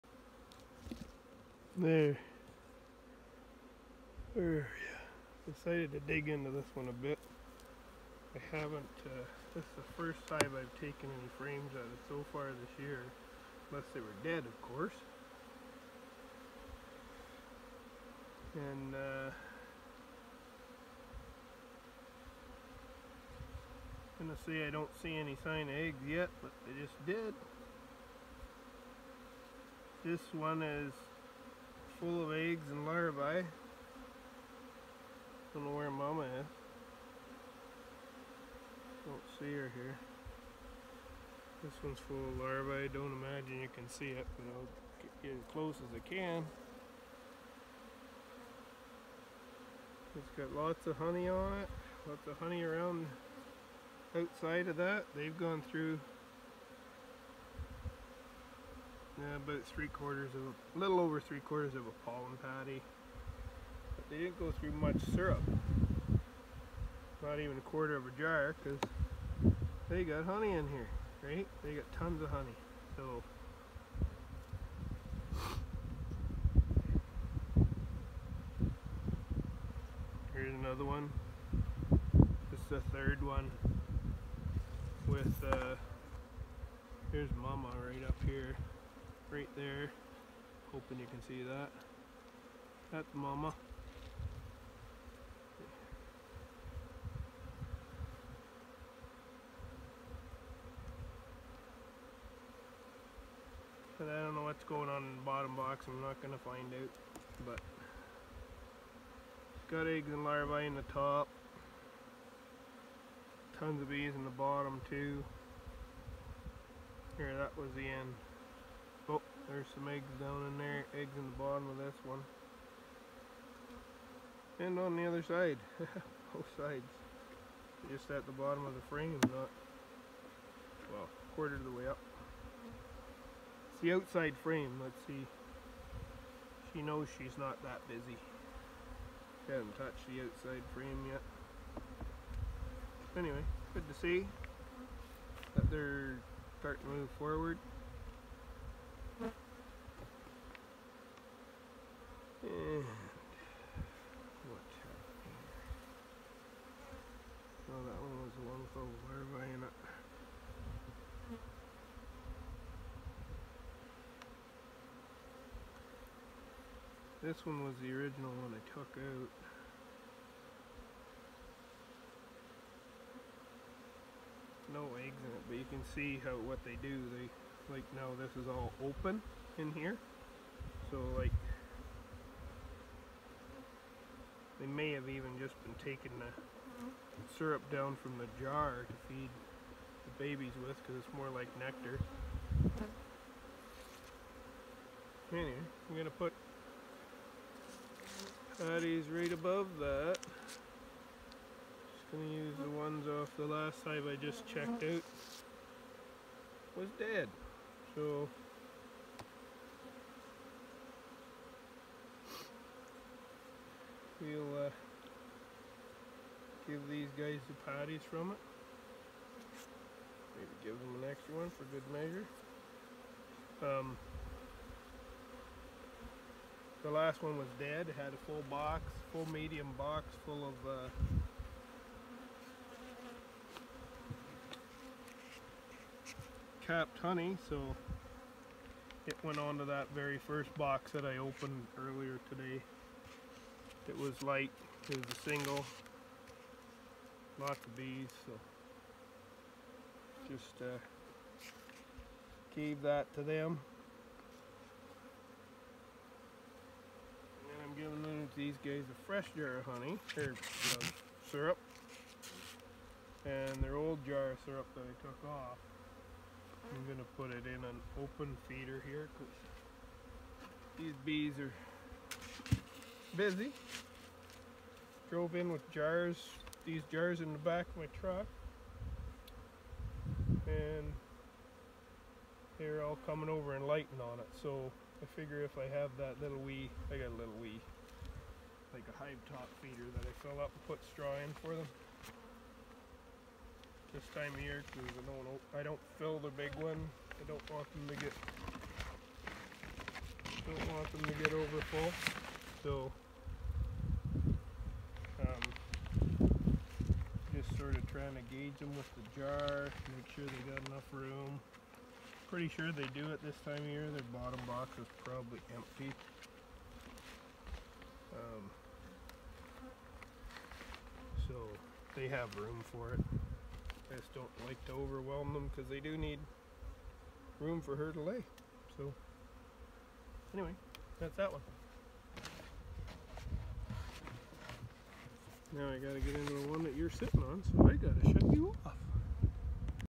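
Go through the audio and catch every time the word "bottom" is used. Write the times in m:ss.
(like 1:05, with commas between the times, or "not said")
1:45, 1:54, 2:01, 2:08, 5:14.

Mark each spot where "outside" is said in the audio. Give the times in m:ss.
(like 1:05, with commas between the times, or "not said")
0:54, 2:13, 2:20.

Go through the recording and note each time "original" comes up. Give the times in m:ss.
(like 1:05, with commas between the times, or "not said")
2:47.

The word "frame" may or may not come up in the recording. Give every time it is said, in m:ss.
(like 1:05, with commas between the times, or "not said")
0:11, 2:08, 2:14, 2:20.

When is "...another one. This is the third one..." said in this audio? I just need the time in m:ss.
1:20.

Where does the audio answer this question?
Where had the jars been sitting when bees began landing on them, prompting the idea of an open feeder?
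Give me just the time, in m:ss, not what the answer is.
4:37.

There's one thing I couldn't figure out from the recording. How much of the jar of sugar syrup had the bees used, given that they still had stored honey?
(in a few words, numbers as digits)
not even a quarter.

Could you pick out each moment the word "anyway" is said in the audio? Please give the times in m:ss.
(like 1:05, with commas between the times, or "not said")
2:23, 3:15, 5:30.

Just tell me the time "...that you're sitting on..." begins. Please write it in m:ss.
5:36.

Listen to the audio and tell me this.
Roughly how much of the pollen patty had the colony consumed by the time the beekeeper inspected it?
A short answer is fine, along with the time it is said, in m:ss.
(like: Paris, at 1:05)
a little over three quarters, at 1:00.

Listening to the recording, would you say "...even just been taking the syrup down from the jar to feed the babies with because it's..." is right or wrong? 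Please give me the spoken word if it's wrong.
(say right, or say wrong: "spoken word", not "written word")
right.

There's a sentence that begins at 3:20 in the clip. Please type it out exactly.
Just gonna use the ones off the last hive I just checked out.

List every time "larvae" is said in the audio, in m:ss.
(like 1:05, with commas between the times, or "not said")
0:32, 0:42, 1:50.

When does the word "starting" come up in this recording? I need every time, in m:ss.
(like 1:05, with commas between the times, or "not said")
2:26.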